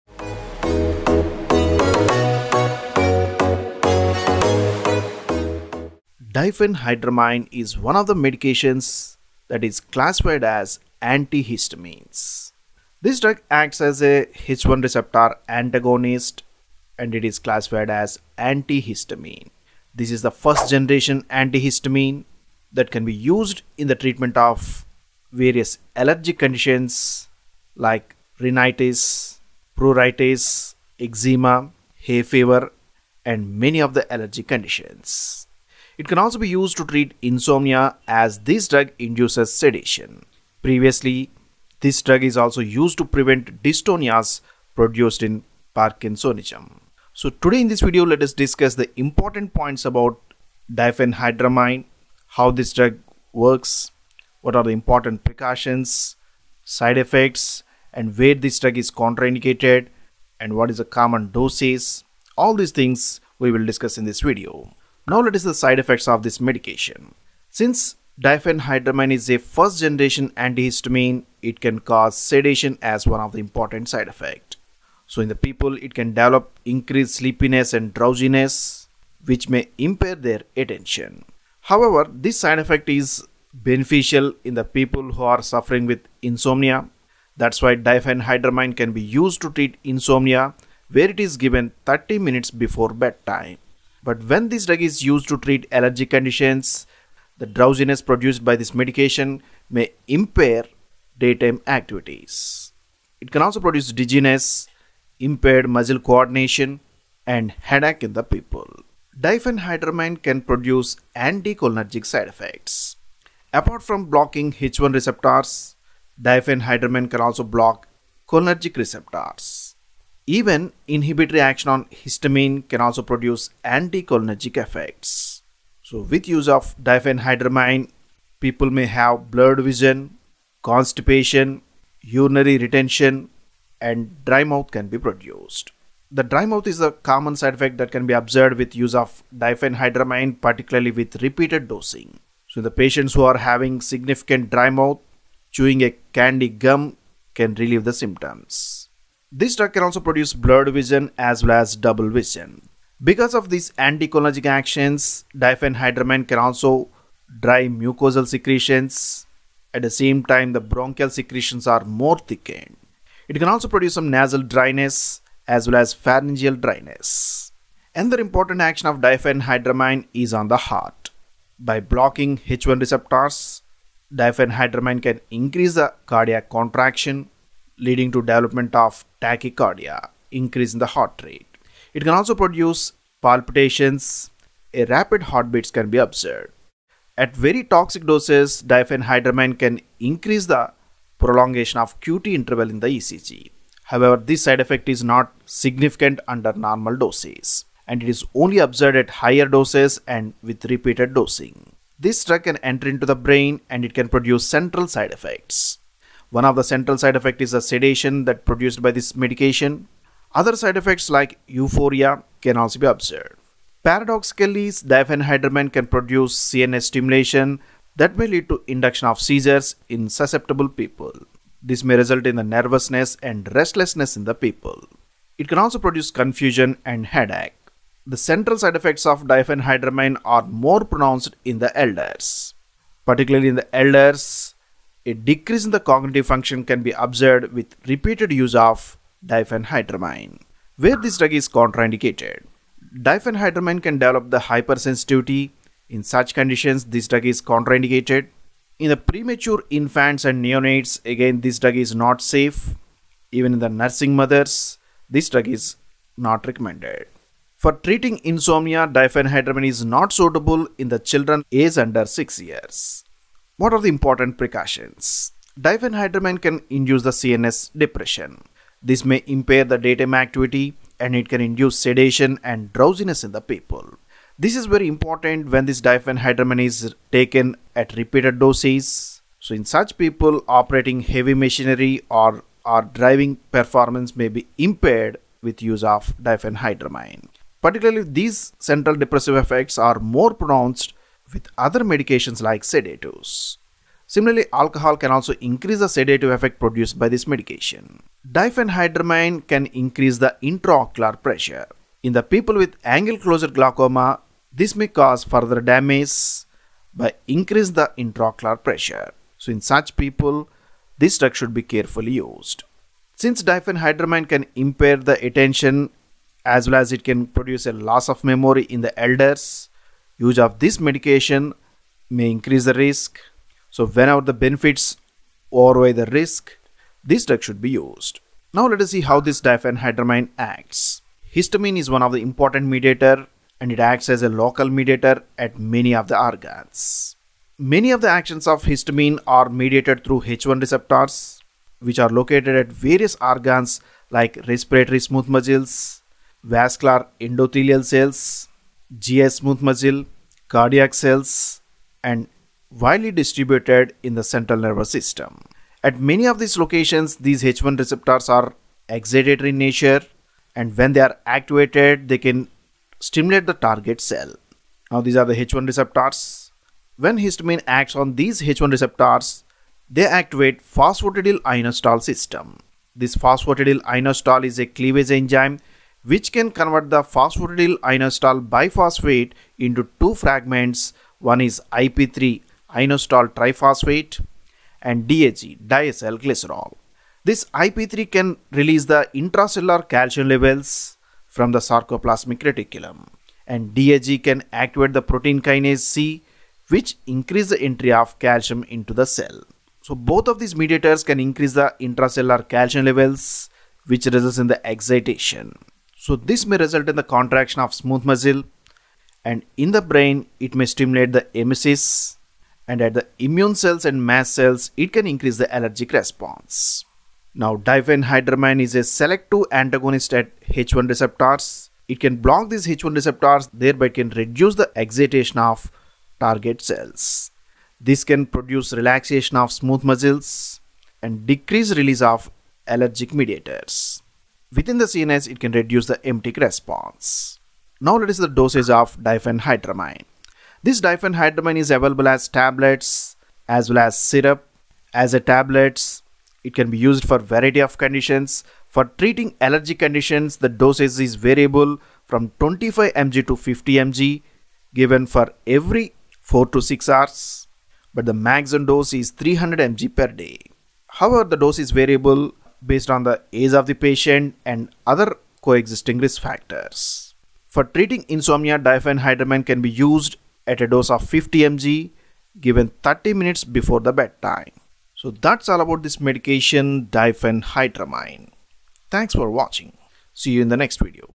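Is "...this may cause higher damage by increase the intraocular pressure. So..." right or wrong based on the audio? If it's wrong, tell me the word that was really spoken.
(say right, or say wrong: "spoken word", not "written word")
wrong: "further", not "higher".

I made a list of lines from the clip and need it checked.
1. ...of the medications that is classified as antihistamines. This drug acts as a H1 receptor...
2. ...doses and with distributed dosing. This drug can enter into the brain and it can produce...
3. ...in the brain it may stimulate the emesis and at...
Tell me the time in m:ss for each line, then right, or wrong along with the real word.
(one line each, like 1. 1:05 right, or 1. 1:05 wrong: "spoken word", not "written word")
1. 0:07 right
2. 3:19 wrong: "repeated", not "distributed"
3. 6:49 right.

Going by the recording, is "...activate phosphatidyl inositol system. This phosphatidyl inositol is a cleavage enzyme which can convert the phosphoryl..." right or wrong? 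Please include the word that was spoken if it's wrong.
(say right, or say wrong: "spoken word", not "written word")
right.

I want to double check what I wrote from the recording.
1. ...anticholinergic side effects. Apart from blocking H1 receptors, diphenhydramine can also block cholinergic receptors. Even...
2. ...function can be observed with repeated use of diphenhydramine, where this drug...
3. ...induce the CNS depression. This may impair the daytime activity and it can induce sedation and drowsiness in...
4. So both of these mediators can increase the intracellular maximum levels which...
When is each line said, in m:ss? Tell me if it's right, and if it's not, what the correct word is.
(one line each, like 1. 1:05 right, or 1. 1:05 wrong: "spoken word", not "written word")
1. 1:51 right
2. 3:56 right
3. 4:26 right
4. 6:39 wrong: "calcium", not "maximum".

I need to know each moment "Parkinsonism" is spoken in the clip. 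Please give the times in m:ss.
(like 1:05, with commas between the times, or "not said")
0:45.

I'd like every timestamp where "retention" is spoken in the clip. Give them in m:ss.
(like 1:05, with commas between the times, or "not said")
2:12.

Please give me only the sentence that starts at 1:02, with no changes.
All these things we will discuss in this video.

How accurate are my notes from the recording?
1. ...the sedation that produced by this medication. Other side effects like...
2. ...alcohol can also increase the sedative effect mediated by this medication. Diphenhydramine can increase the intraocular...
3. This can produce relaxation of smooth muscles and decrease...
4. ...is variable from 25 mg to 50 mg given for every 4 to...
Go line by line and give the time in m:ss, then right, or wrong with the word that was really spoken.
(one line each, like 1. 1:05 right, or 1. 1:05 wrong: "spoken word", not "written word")
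1. 3:27 right
2. 4:54 wrong: "produced", not "mediated"
3. 7:07 right
4. 7:30 right.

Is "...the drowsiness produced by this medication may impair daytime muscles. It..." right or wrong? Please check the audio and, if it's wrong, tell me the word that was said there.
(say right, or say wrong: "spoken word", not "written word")
wrong: "activities", not "muscles".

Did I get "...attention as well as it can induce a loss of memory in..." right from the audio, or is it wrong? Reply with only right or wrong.
wrong.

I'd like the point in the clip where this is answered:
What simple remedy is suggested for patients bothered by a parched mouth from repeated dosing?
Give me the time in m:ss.
2:25.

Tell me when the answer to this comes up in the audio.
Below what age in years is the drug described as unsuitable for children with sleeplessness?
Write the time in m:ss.
4:22.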